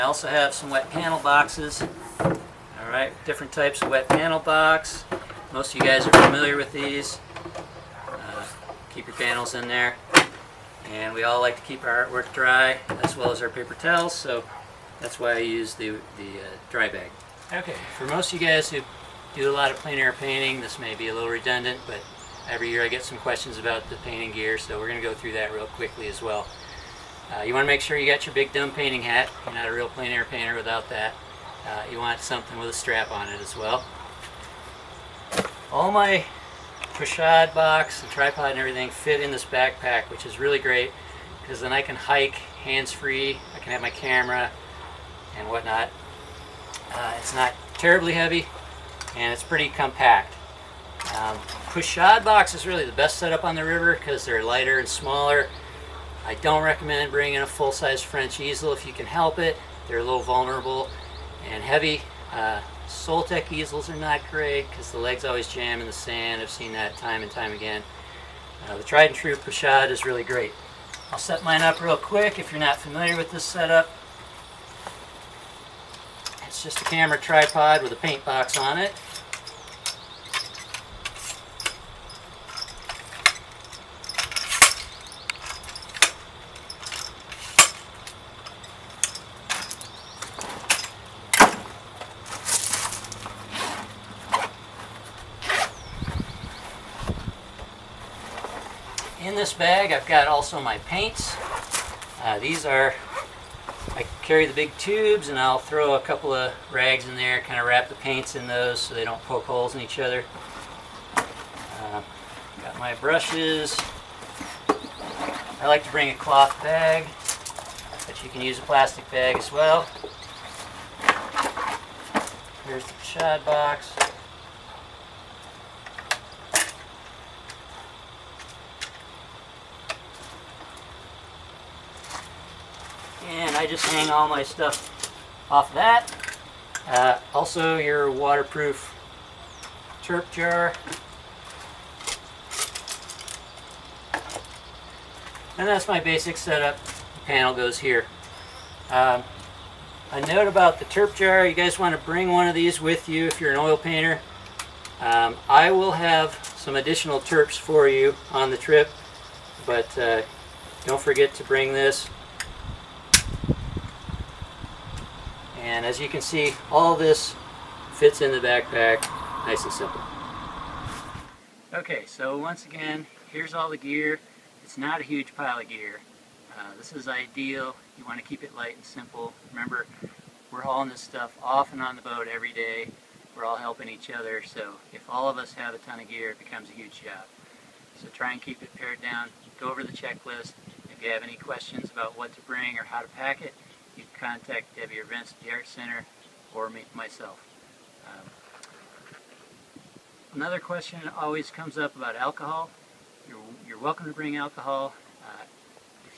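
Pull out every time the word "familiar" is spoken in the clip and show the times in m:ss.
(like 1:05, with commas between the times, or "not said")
0:06, 1:12.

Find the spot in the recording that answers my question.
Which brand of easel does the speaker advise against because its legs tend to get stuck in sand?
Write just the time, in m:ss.
1:02.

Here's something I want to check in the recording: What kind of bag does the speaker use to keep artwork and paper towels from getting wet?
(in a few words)
dry bag.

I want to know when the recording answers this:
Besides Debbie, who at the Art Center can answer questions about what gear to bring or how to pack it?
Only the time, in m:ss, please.
3:15.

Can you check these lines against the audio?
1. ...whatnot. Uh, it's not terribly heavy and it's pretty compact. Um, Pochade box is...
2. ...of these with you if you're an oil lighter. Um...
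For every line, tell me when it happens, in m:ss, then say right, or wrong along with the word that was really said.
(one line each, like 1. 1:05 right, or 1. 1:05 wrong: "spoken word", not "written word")
1. 0:45 right
2. 2:32 wrong: "painter", not "lighter".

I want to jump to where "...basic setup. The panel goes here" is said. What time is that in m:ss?
2:26.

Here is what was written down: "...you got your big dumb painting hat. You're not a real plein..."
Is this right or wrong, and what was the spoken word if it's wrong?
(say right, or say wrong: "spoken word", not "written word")
right.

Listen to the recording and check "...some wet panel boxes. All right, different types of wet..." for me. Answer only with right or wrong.
right.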